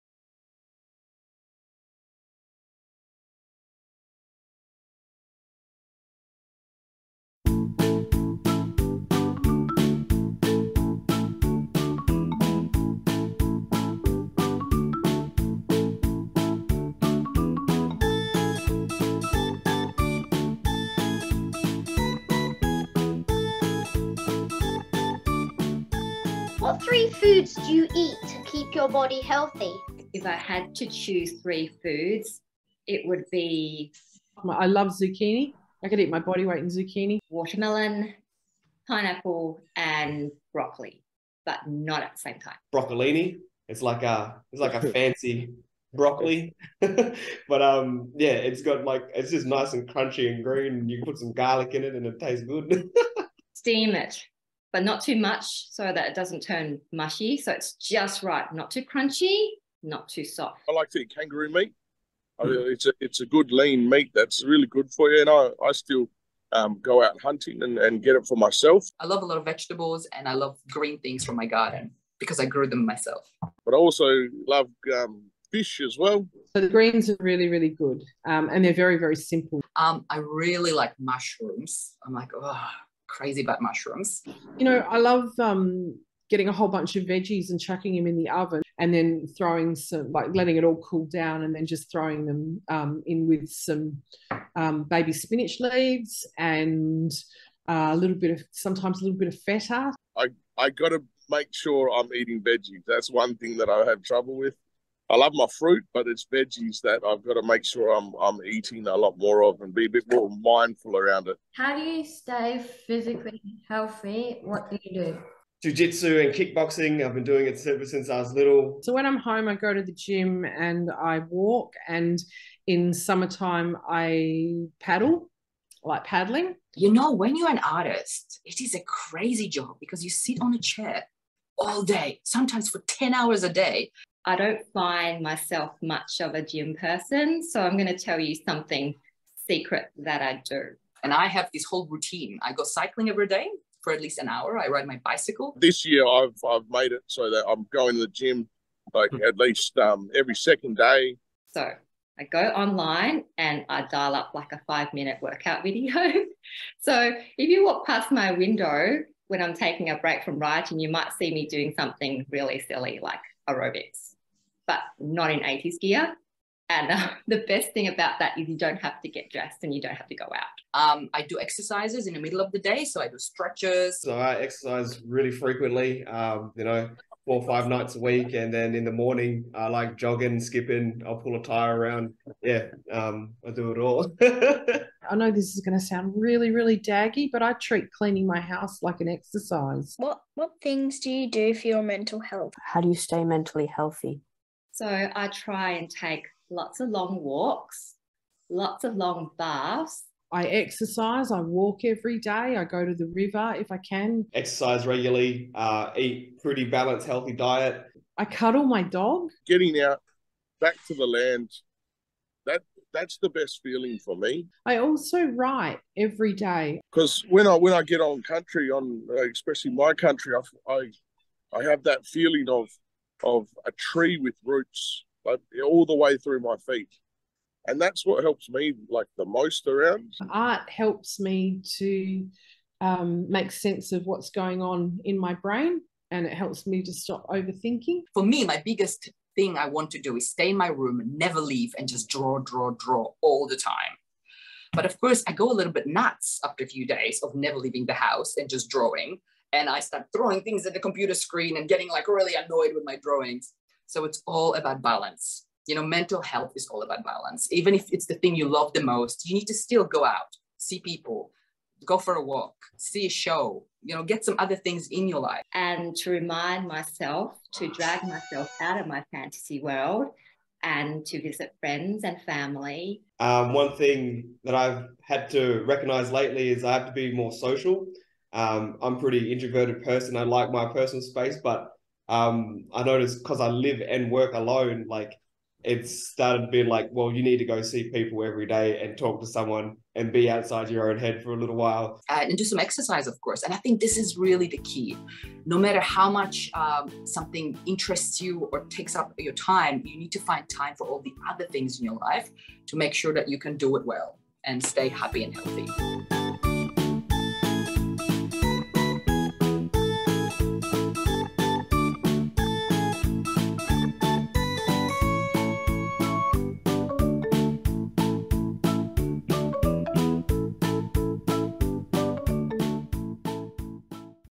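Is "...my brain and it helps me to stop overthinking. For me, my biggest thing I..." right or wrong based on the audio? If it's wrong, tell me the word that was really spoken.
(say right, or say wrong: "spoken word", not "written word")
right.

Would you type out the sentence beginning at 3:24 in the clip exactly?
Exercise regularly, uh, eat pretty balanced, healthy diet.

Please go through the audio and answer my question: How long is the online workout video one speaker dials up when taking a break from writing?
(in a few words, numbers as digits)
5 minutes.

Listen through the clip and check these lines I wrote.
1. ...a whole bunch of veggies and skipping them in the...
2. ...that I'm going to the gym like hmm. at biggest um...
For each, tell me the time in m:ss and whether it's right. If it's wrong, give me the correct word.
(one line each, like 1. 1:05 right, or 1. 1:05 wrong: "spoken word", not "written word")
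1. 1:26 wrong: "chucking", not "skipping"
2. 2:27 wrong: "least", not "biggest".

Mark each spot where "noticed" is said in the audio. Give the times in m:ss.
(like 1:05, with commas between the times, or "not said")
4:42.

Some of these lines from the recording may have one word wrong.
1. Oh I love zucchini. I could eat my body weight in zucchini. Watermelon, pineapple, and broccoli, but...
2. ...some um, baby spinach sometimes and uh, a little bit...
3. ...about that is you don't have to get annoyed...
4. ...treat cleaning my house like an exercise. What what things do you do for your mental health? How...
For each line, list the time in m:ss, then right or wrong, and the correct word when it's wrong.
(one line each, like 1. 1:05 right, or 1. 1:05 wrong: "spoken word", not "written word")
1. 0:34 right
2. 1:33 wrong: "leaves", not "sometimes"
3. 2:47 wrong: "dressed", not "annoyed"
4. 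3:07 right.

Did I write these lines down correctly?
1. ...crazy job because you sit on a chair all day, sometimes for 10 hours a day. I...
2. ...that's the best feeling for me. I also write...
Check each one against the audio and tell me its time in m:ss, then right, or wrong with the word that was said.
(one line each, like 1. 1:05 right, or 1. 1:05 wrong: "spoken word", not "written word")
1. 2:08 right
2. 3:32 right.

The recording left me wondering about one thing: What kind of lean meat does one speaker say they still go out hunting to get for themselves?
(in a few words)
Kangaroo.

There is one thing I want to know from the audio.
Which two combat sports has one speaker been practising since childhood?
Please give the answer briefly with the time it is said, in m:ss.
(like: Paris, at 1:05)
Jiu-jitsu and kickboxing, at 1:55.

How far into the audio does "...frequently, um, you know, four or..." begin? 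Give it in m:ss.
2:55.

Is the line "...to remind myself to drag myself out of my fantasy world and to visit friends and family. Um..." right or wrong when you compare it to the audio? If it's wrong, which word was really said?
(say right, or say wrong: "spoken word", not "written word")
right.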